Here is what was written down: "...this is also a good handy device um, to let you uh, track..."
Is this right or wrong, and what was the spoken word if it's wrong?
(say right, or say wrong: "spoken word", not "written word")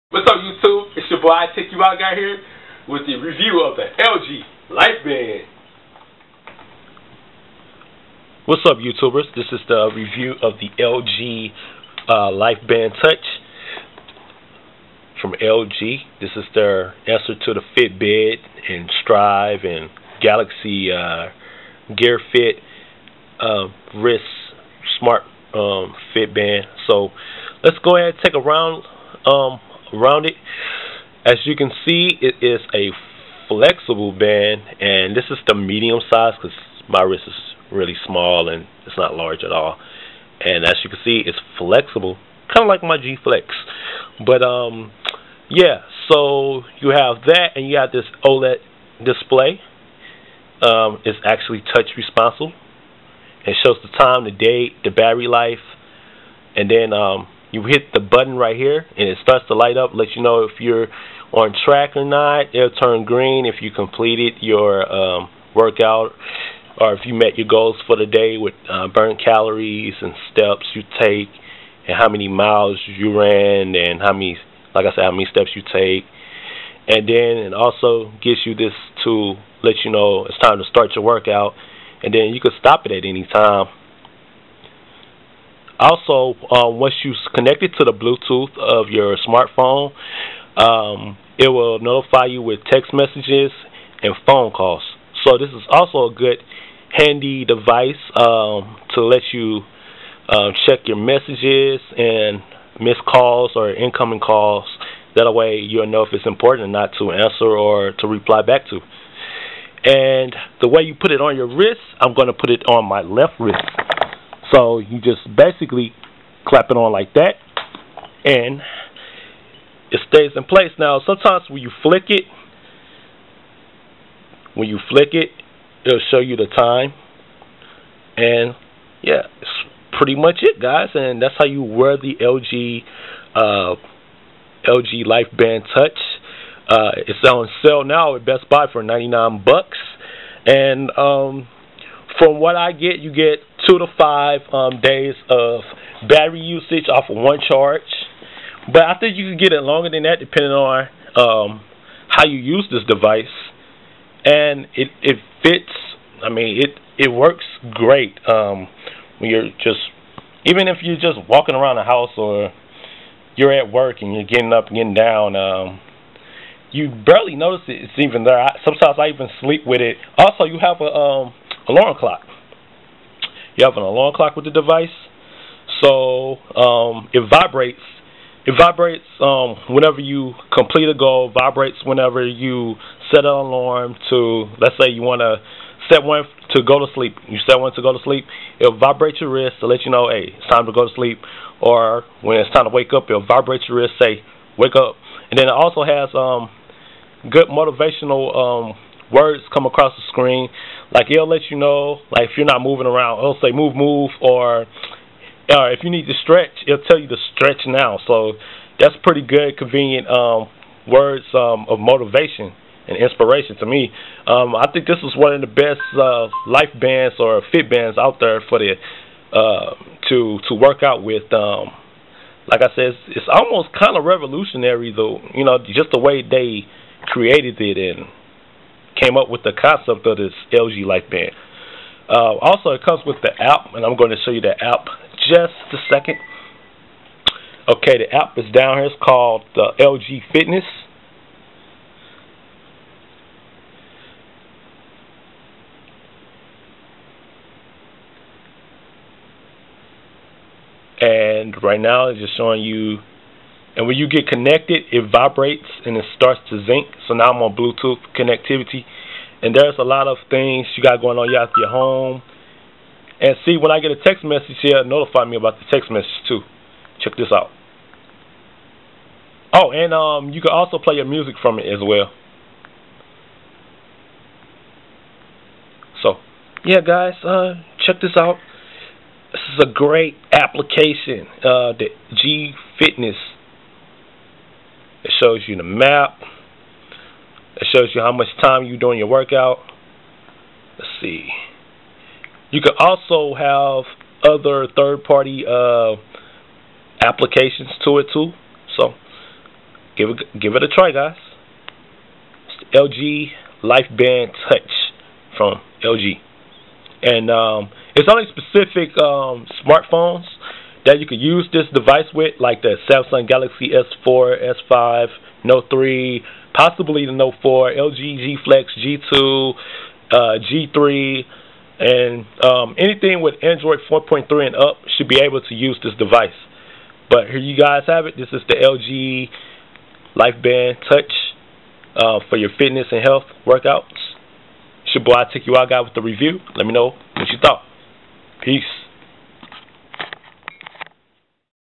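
wrong: "check", not "track".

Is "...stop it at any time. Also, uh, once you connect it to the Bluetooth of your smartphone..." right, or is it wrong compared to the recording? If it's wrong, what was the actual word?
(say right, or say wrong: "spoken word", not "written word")
right.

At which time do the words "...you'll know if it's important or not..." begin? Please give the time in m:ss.
1:45.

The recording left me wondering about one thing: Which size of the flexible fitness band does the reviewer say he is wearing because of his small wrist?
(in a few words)
medium.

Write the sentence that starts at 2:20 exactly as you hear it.
And um, from what I get, you get two to five um, days of battery usage off of one charge.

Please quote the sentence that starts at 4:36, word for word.
So, yeah, guys, uh, check this out.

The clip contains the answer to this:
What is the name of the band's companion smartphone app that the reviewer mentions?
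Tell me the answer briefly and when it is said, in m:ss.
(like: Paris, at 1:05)
LG Fitness, at 3:59.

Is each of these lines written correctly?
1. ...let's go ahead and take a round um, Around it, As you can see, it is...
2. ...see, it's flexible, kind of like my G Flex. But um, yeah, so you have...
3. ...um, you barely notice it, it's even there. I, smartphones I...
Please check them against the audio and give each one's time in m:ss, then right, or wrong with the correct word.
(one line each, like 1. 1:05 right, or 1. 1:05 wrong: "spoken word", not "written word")
1. 0:27 right
2. 0:41 right
3. 2:45 wrong: "sometimes", not "smartphones".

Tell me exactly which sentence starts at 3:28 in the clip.
So that's pretty good, convenient um, words um, of motivation and inspiration to me.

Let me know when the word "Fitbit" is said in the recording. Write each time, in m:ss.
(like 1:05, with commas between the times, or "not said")
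0:17.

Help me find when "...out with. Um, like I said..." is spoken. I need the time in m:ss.
3:40.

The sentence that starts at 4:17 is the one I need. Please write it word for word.
So now I'm on Bluetooth connectivity.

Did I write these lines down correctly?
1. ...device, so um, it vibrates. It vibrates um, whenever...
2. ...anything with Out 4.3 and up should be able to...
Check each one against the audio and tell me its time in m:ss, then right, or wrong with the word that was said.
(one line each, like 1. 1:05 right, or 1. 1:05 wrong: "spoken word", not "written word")
1. 2:54 right
2. 5:22 wrong: "Android", not "Out".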